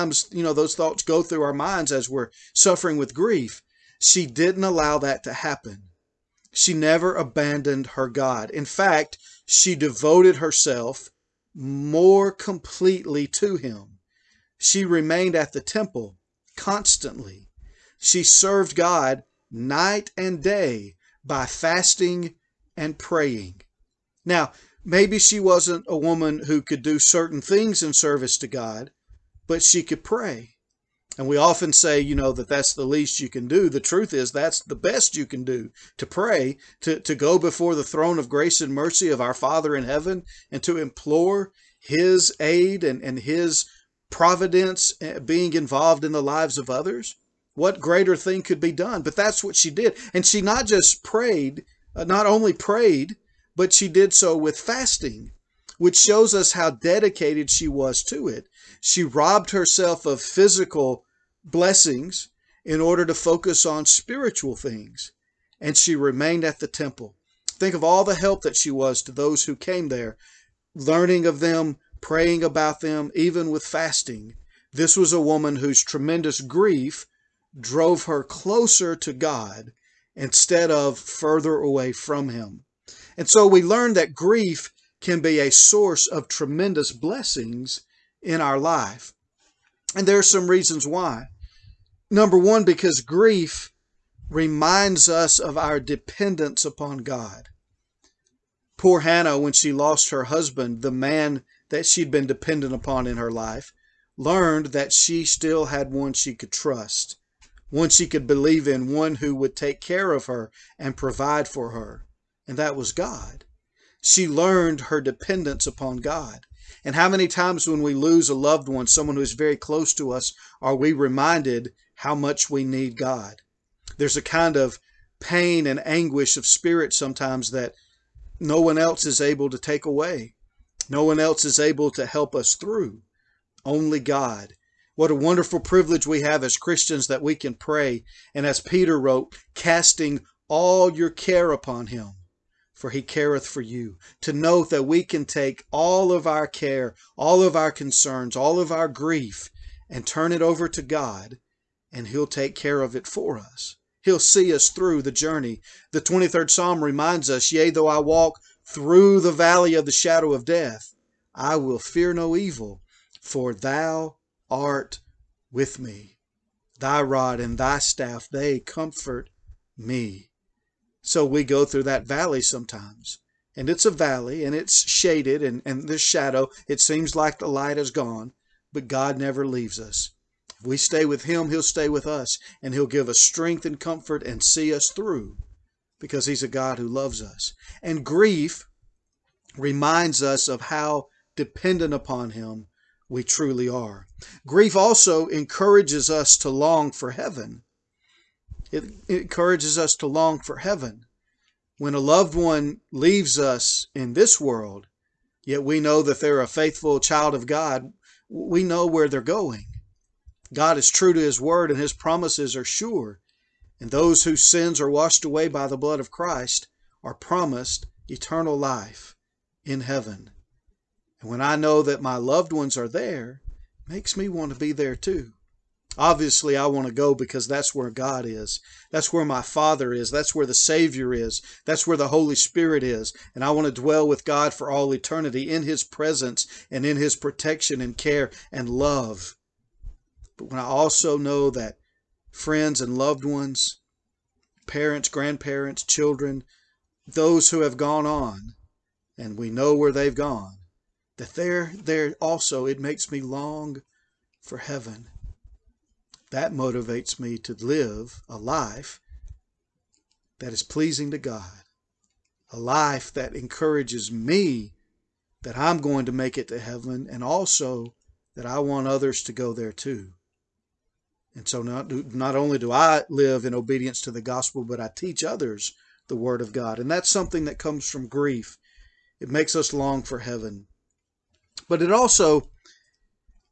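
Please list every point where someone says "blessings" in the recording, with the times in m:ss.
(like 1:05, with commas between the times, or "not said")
1:01, 1:26.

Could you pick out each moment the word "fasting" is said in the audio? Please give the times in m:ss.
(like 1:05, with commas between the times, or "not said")
0:21, 0:54, 1:13.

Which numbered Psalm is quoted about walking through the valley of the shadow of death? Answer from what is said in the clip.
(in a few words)
23rd Psalm.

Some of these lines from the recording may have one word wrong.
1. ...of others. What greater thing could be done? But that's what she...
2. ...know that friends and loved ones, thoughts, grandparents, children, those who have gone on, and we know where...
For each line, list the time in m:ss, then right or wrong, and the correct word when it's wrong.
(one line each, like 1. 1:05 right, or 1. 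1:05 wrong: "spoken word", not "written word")
1. 0:46 right
2. 4:01 wrong: "parents", not "thoughts".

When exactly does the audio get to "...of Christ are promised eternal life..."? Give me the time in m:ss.
3:35.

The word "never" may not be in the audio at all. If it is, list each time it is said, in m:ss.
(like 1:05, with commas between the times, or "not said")
0:06, 2:59.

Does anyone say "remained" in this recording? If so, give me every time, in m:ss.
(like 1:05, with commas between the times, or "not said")
0:14, 1:05.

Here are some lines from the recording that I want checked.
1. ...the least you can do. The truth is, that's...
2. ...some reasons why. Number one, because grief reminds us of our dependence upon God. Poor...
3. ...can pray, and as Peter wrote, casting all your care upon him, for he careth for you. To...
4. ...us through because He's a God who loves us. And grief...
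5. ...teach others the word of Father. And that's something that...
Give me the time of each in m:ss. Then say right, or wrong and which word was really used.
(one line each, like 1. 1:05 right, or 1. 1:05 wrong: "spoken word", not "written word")
1. 0:32 right
2. 1:30 right
3. 2:17 right
4. 3:04 right
5. 4:34 wrong: "God", not "Father".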